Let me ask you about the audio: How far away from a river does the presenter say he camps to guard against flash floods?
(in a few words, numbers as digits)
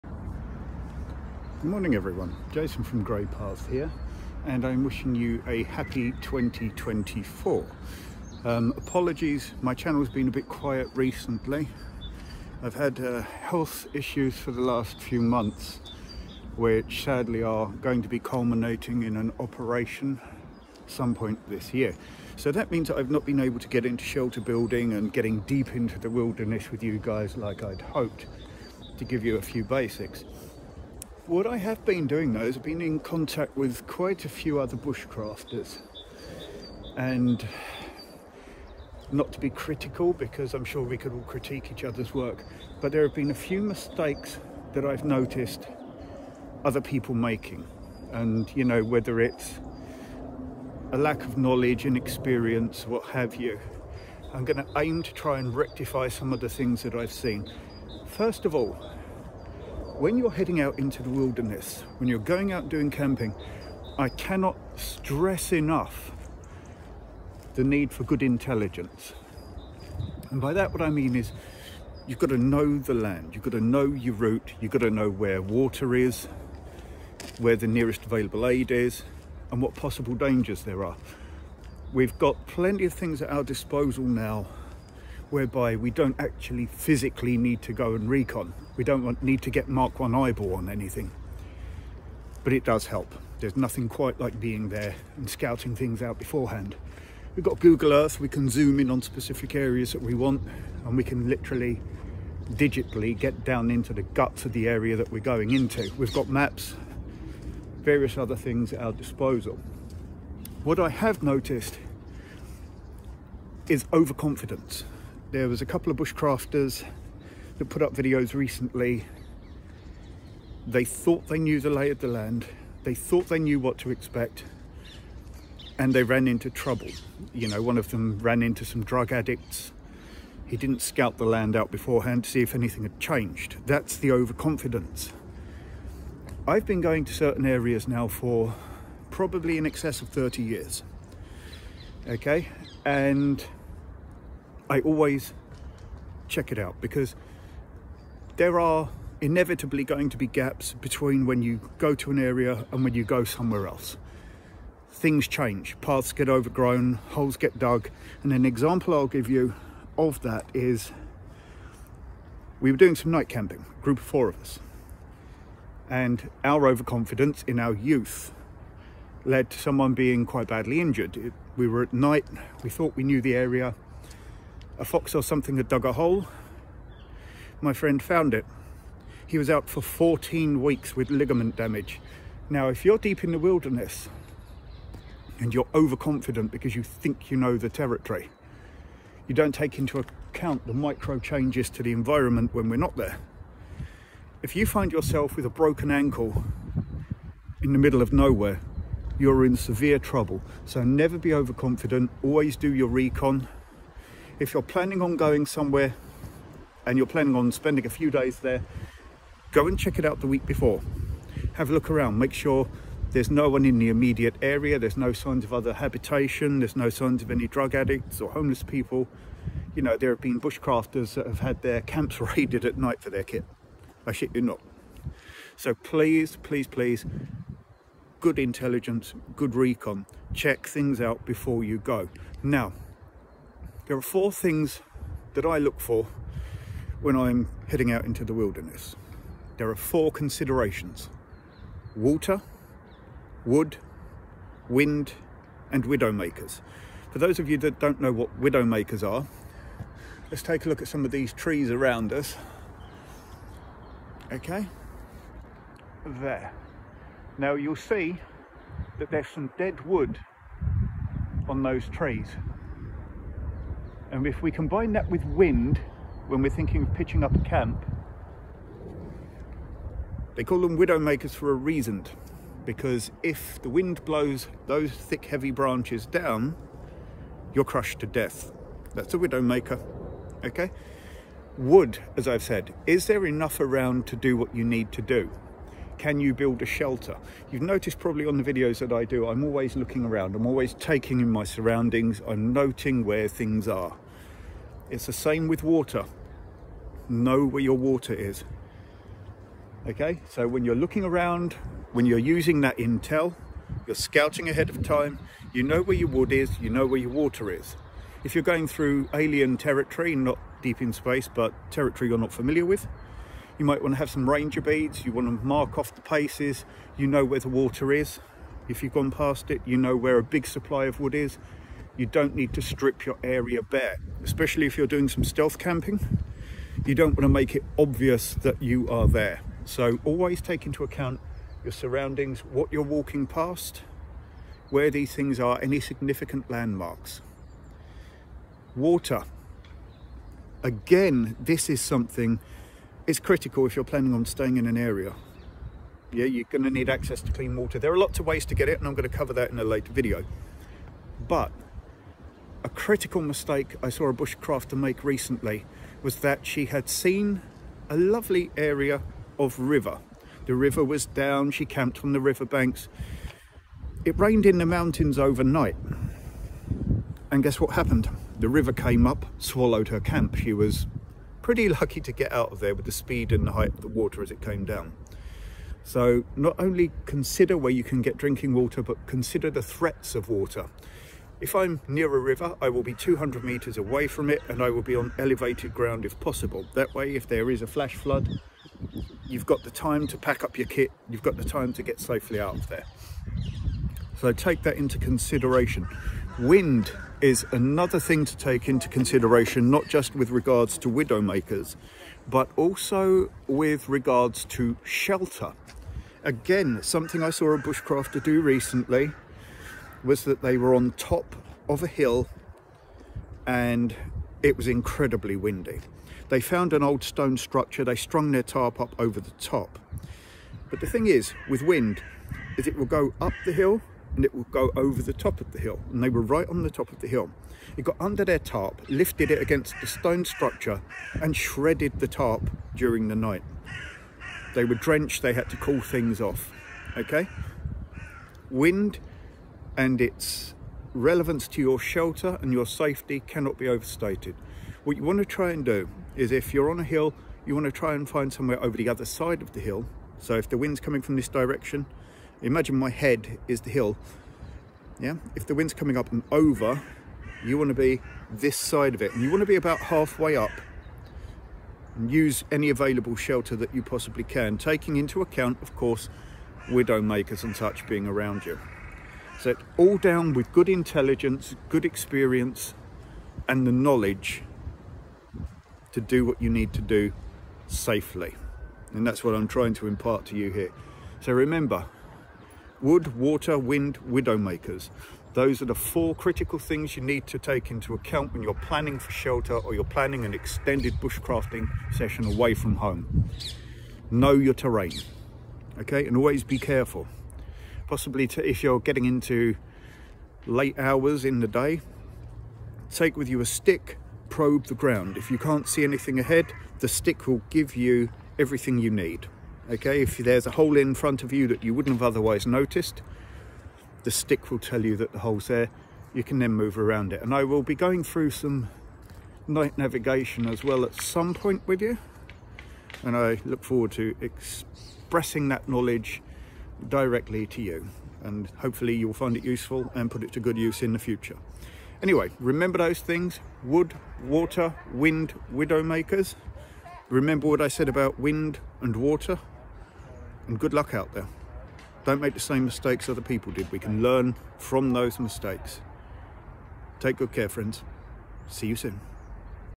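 200 meters.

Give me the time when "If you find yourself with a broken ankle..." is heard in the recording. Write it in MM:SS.
03:14.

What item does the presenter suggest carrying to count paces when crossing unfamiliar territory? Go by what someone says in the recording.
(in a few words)
Ranger beads.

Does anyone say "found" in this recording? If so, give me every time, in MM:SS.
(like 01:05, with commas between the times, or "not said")
02:58, 06:56.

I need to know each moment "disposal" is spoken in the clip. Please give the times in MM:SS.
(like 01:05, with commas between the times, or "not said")
01:23, 01:48.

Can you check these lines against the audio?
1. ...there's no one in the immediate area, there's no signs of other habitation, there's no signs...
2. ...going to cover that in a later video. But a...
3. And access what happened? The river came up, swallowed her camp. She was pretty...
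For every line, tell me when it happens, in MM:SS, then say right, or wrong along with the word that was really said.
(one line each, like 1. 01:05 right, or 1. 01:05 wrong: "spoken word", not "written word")
1. 03:33 right
2. 05:48 right
3. 06:07 wrong: "guess", not "access".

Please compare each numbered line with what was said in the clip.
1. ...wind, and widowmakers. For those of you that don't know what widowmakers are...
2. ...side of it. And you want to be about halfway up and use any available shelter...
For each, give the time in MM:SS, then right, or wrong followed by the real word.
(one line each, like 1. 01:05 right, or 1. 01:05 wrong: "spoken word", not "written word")
1. 04:04 right
2. 07:38 right.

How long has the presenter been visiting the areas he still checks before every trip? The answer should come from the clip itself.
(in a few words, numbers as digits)
30 years.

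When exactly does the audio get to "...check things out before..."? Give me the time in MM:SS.
03:50.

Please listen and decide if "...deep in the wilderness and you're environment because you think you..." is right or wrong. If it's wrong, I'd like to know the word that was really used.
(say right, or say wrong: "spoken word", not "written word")
wrong: "overconfident", not "environment".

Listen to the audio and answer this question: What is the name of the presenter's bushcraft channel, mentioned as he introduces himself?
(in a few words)
Grey Path.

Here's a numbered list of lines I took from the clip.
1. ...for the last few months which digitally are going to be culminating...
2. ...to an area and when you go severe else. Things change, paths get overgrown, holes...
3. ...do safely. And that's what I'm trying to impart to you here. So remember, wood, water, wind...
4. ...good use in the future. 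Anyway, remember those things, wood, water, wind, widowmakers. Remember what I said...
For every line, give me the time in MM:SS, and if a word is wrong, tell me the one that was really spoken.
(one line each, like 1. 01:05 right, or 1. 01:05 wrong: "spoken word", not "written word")
1. 00:14 wrong: "sadly", not "digitally"
2. 02:31 wrong: "somewhere", not "severe"
3. 07:56 right
4. 08:50 right.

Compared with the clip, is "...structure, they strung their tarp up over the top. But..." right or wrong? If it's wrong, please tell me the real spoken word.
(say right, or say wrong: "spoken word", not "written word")
right.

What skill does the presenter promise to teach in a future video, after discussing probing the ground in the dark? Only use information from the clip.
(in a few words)
Night navigation.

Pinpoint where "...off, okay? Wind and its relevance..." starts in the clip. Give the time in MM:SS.
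07:16.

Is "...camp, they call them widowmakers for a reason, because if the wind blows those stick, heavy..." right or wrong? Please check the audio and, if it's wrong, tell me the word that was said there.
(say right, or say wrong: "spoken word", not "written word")
wrong: "thick", not "stick".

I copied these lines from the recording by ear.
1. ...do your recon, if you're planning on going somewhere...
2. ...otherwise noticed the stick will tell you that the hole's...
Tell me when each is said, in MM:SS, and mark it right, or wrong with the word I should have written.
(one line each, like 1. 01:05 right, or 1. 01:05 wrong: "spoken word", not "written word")
1. 03:22 right
2. 08:32 right.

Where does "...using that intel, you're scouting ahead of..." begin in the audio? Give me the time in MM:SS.
05:02.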